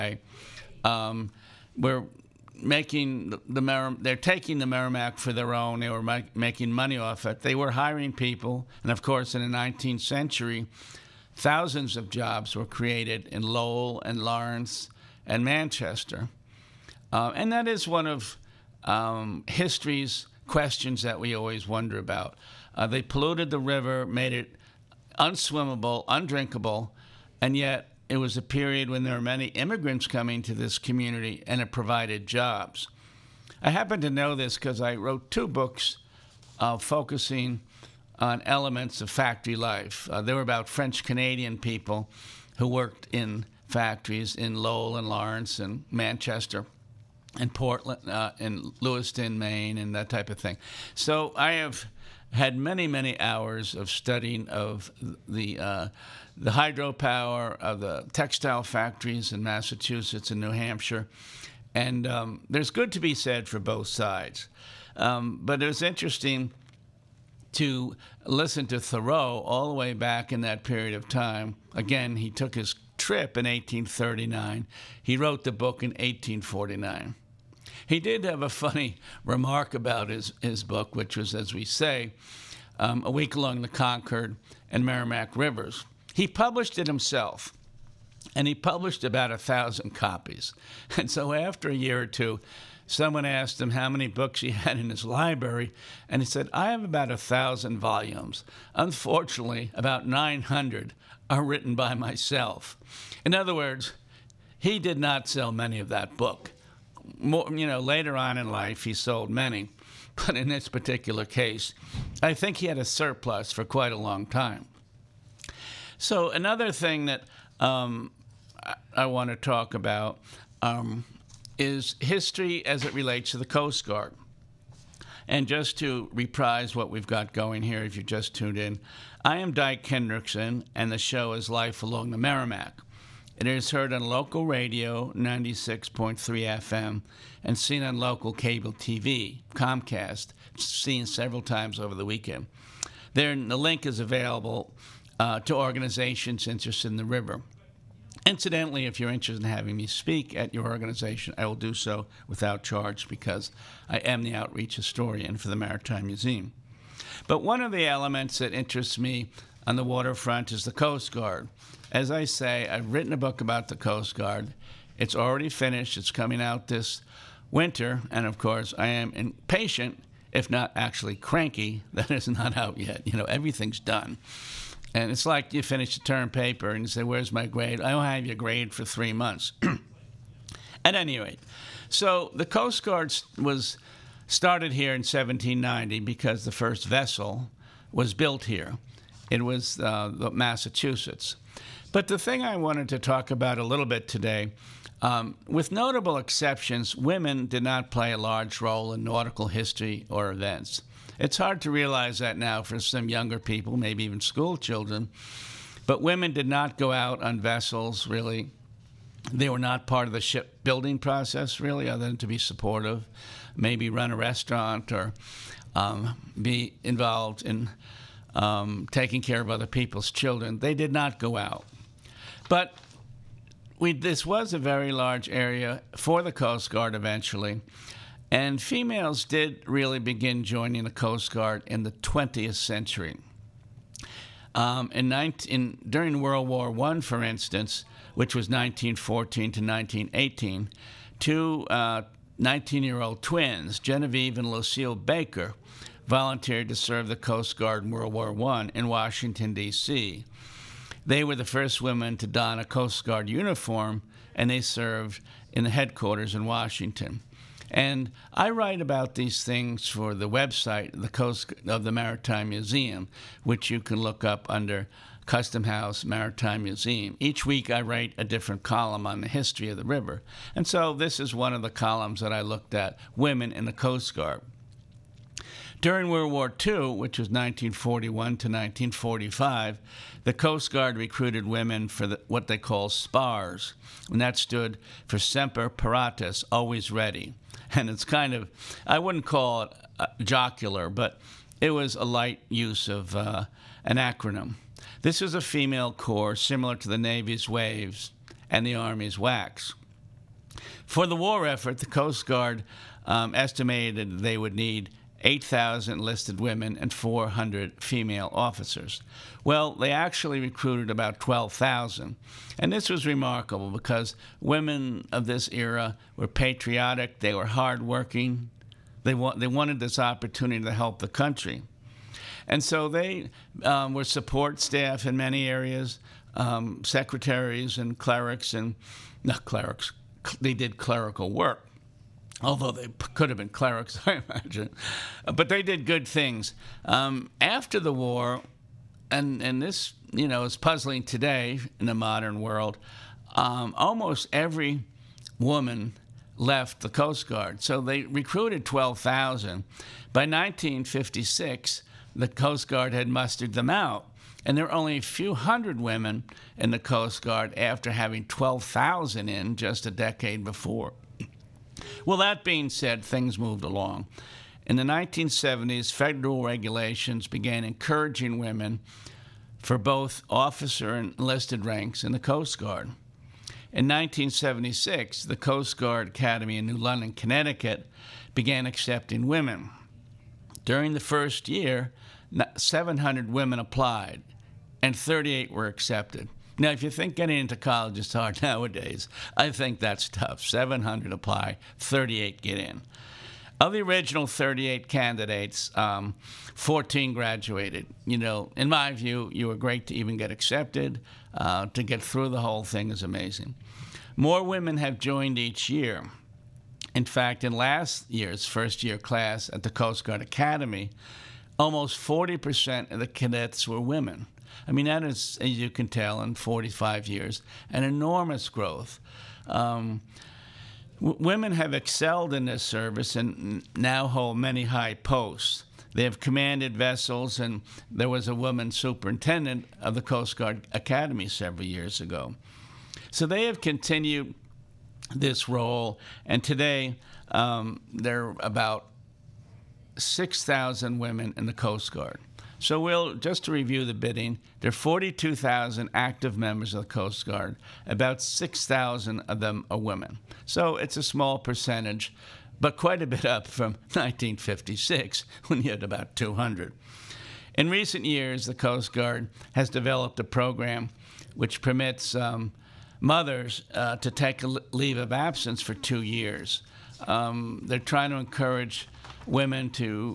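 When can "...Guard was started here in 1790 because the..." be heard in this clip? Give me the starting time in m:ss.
3:02.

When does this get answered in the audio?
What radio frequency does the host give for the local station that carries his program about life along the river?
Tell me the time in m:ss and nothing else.
2:15.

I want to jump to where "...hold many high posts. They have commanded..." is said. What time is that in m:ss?
7:04.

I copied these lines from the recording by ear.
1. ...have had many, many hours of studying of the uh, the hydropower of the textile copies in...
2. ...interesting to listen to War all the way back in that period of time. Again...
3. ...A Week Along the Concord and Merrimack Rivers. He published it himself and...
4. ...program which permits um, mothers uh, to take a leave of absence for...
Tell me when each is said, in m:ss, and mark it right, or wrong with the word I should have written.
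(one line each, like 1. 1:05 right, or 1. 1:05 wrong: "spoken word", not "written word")
1. 0:51 wrong: "factories", not "copies"
2. 1:05 wrong: "Thoreau", not "War"
3. 1:23 right
4. 7:40 right.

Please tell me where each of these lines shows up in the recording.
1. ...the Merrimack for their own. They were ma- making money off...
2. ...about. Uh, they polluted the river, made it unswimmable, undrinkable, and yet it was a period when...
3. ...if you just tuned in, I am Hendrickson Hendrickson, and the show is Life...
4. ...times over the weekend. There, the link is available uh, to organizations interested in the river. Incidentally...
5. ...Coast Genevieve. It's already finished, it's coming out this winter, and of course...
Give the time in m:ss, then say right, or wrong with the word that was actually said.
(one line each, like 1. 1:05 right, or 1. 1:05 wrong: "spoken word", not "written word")
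1. 0:04 right
2. 0:21 right
3. 2:07 wrong: "Dyke", not "Hendrickson"
4. 2:21 right
5. 2:43 wrong: "Guard", not "Genevieve".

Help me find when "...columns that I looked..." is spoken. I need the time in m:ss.
4:31.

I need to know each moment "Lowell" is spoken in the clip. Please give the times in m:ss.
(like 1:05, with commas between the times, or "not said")
0:13, 0:44.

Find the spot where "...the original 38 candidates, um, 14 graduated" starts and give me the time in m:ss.
6:33.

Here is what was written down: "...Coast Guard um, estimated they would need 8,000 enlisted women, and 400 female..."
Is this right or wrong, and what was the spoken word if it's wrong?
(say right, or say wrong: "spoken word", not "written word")
right.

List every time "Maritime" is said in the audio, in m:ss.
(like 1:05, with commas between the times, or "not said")
2:35, 4:21, 4:26.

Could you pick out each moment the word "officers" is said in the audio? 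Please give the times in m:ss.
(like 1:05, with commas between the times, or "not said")
5:08, 6:10.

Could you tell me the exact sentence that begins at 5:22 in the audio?
And so they um, were support staff in many areas, um, secretaries and clerics and not clerics.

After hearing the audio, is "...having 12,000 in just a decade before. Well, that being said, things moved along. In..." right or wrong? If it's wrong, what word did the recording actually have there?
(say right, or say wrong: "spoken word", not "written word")
right.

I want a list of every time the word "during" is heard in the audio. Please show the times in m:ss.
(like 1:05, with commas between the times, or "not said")
3:55, 4:35, 6:20.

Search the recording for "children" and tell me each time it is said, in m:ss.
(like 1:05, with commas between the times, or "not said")
3:24, 3:40.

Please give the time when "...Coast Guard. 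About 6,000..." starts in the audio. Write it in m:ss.
7:26.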